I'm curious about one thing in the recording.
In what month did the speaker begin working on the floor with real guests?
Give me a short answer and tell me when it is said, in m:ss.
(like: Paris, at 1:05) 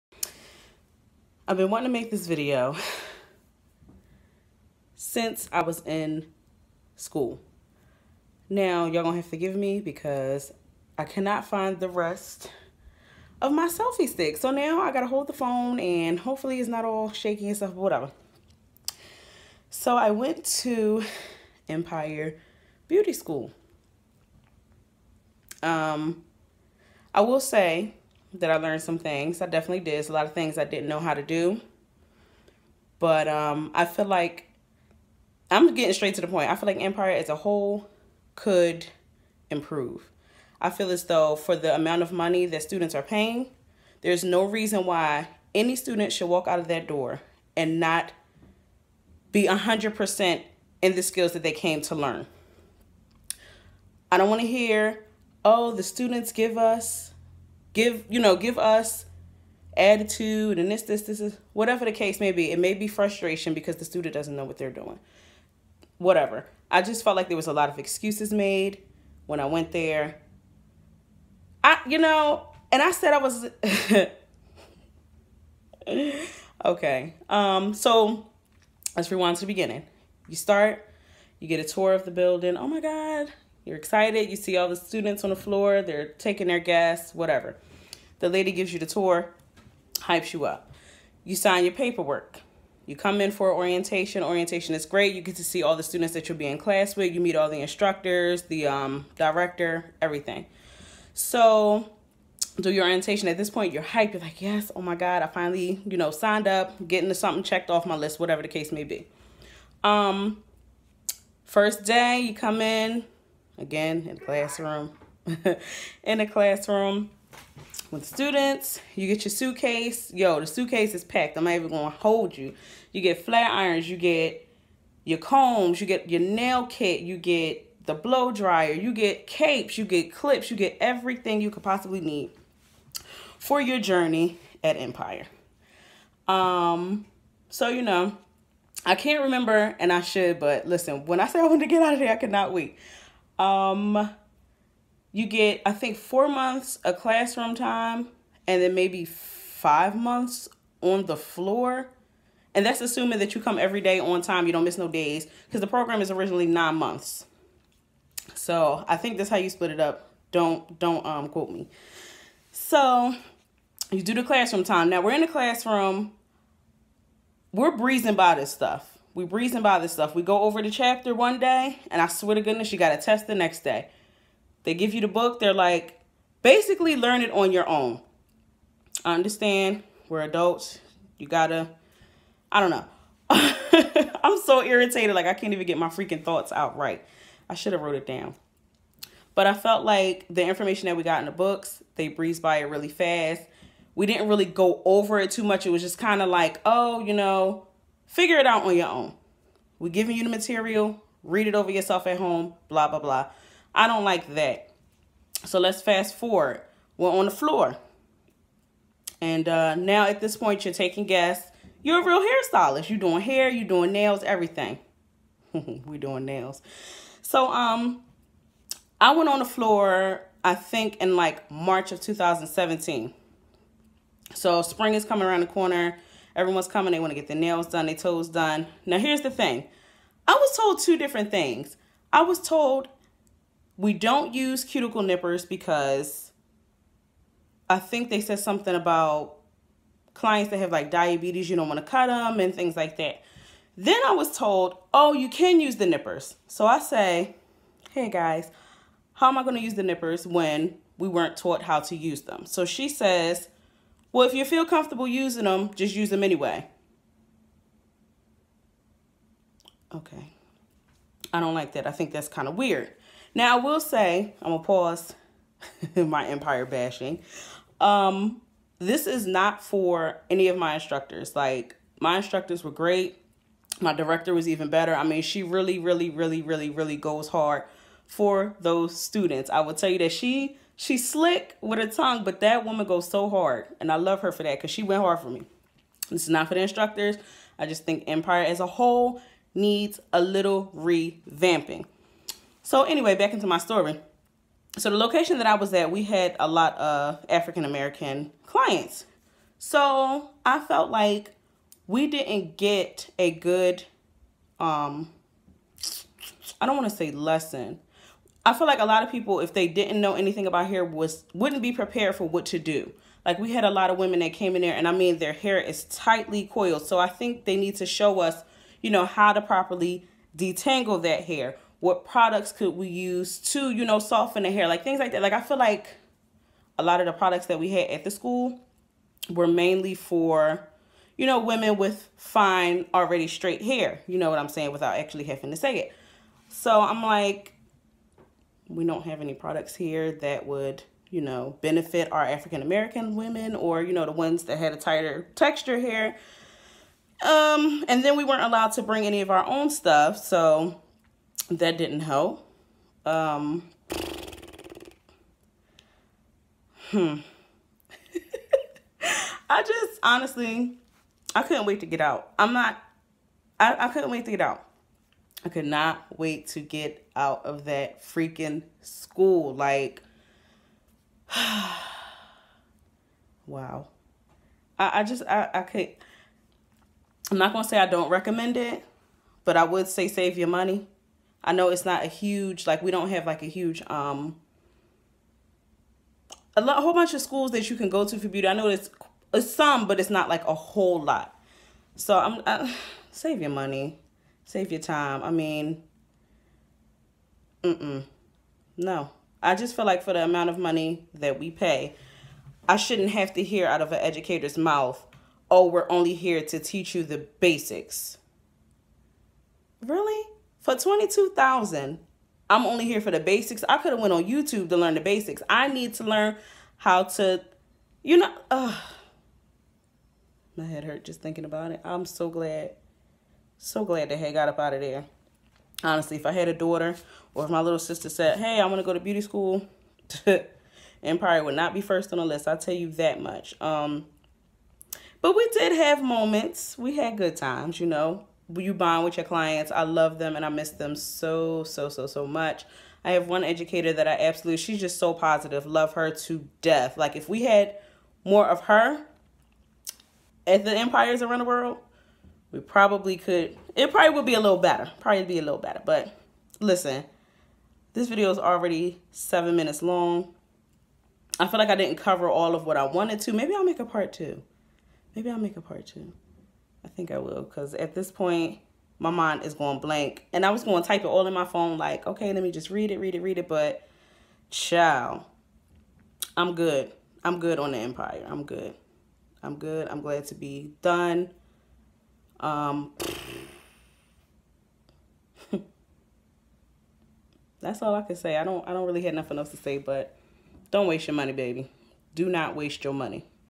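March, at 3:41.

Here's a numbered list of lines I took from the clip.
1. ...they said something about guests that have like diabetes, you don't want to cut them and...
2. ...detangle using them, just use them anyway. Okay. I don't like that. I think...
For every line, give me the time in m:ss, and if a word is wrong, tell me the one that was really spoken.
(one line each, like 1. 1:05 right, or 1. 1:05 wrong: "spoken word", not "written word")
1. 3:58 wrong: "clients", not "guests"
2. 4:14 wrong: "comfortable", not "detangle".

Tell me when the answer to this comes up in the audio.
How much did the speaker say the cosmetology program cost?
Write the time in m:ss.
6:50.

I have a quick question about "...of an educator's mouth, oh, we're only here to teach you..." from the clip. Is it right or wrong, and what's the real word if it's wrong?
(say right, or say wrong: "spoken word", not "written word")
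right.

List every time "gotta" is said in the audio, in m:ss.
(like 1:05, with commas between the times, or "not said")
0:14, 3:01.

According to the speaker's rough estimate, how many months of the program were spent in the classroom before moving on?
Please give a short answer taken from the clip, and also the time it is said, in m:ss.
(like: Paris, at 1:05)
4, at 2:25.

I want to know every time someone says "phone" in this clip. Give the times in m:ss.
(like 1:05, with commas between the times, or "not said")
0:15, 7:51.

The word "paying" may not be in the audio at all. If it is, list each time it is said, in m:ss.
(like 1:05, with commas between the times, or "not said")
0:43.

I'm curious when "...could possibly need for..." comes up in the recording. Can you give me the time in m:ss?
2:11.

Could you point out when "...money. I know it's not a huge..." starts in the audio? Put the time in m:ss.
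6:20.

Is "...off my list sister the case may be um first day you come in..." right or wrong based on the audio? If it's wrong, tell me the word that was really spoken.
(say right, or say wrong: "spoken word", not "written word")
wrong: "whatever", not "sister".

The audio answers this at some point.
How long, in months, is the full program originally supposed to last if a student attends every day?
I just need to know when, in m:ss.
2:36.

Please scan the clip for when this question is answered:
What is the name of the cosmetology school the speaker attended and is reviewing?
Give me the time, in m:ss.
0:21.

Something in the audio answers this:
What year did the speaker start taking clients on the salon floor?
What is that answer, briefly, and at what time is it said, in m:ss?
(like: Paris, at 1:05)
2017, at 3:42.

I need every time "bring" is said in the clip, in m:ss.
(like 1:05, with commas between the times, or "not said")
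5:48.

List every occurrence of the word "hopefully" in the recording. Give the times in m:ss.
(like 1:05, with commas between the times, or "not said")
0:16.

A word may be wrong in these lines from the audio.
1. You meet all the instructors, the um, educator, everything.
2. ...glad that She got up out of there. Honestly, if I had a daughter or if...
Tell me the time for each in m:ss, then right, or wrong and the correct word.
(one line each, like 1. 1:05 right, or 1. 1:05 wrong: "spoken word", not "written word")
1. 1:37 wrong: "director", not "educator"
2. 7:03 wrong: "Hay", not "She".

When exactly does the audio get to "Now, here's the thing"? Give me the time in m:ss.
3:48.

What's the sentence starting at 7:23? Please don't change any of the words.
I have one educator that I absolutely, she's just so positive.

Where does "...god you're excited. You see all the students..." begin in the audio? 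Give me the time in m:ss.
1:22.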